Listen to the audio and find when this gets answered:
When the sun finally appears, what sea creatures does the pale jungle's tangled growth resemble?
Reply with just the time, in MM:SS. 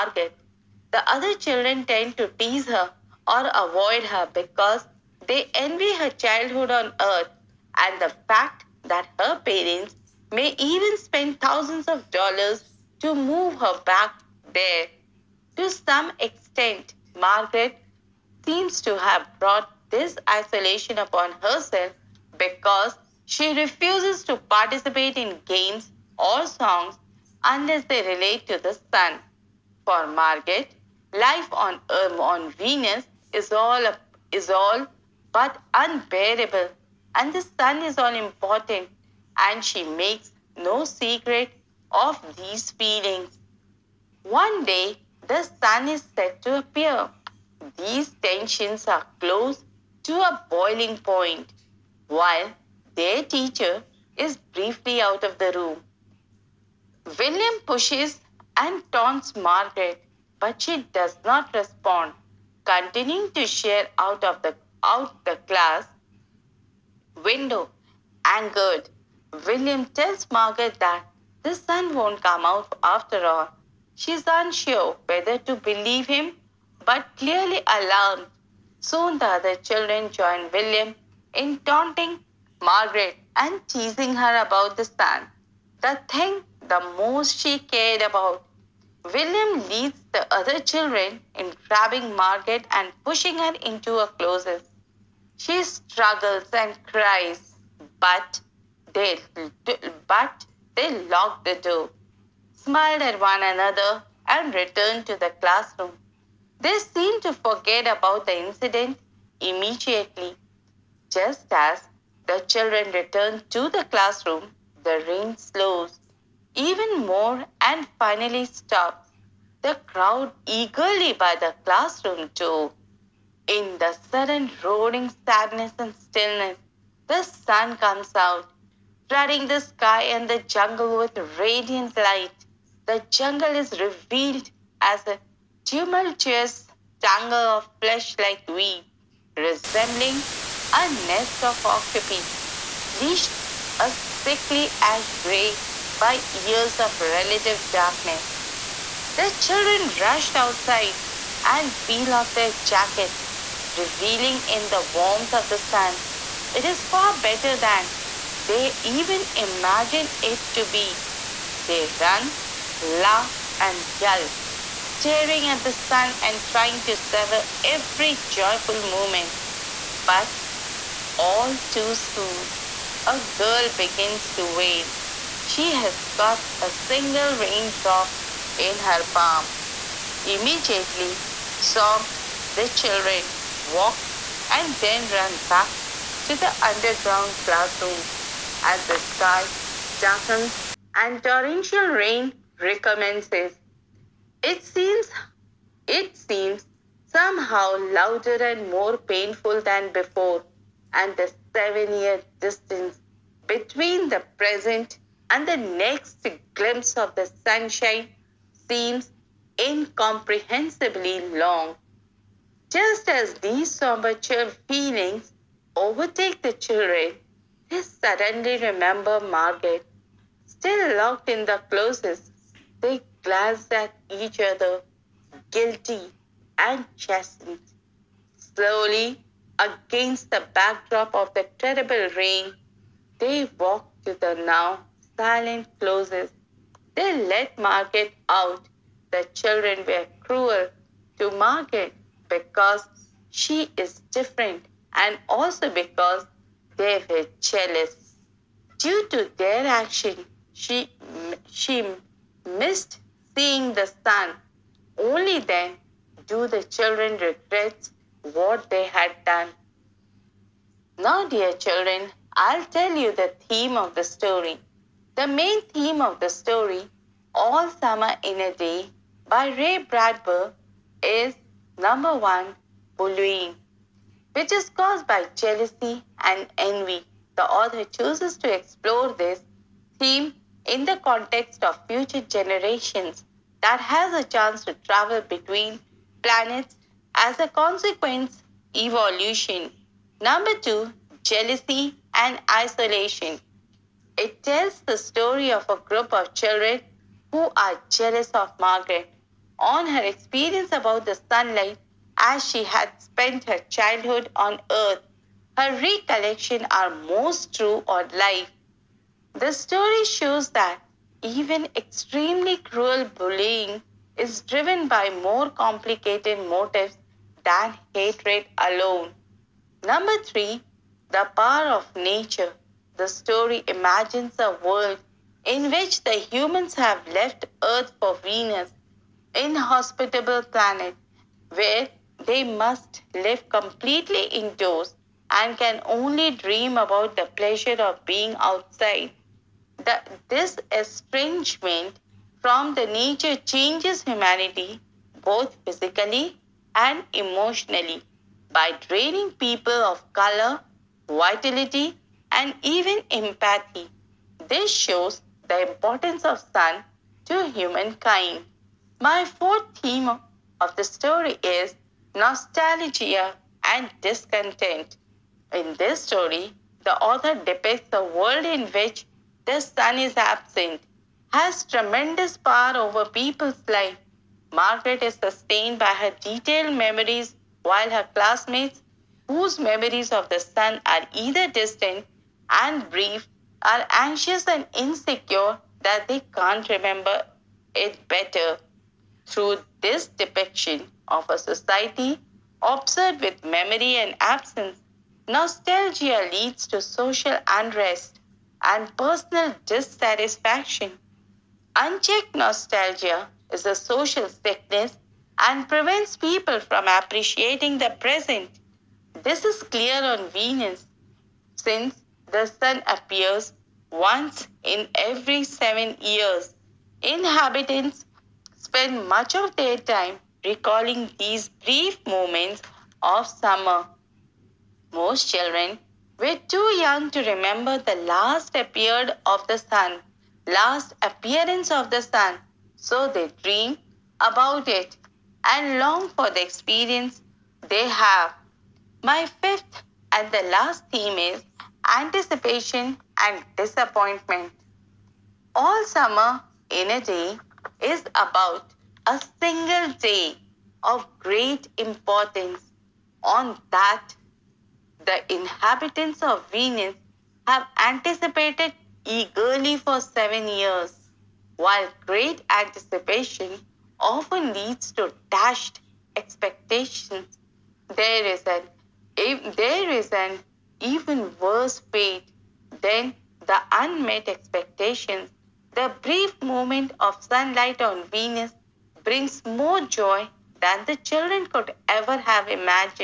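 02:21.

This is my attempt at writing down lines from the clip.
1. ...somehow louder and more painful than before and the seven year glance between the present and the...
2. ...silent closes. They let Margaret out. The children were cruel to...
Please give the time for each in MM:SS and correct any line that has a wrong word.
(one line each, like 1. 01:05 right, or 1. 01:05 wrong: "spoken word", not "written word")
1. 03:17 wrong: "distance", not "glance"
2. 03:55 right.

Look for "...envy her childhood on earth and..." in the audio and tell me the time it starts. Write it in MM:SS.
00:05.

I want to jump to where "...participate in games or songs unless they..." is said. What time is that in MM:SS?
00:24.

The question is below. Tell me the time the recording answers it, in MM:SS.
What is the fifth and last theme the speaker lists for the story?
07:21.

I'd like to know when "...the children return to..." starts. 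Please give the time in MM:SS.
01:52.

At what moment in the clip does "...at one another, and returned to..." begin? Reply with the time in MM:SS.
01:43.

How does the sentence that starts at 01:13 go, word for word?
She is unsure whether to believe him, but clearly alarmed.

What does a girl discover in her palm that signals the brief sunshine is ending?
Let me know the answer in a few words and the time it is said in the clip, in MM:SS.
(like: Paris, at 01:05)
A single raindrop, at 02:56.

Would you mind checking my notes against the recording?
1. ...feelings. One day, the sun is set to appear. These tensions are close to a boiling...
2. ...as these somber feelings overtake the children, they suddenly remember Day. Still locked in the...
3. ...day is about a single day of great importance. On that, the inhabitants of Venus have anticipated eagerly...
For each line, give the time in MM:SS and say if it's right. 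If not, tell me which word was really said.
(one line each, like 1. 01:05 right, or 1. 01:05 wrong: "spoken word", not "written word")
1. 00:42 right
2. 03:33 wrong: "Margaret", not "Day"
3. 07:27 right.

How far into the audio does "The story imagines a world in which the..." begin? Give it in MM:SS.
05:22.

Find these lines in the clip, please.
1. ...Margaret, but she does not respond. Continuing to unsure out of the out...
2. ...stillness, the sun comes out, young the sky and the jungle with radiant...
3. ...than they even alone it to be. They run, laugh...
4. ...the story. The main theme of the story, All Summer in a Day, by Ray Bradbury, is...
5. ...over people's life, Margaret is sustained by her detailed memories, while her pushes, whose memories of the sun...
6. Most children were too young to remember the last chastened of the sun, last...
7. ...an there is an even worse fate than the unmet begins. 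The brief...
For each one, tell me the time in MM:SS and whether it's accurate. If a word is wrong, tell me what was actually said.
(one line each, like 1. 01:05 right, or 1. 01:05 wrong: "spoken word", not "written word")
1. 00:59 wrong: "share", not "unsure"
2. 02:05 wrong: "flooding", not "young"
3. 02:37 wrong: "imagine", not "alone"
4. 04:23 right
5. 06:12 wrong: "classmates", not "pushes"
6. 07:05 wrong: "appeared", not "chastened"
7. 07:48 wrong: "expectations", not "begins".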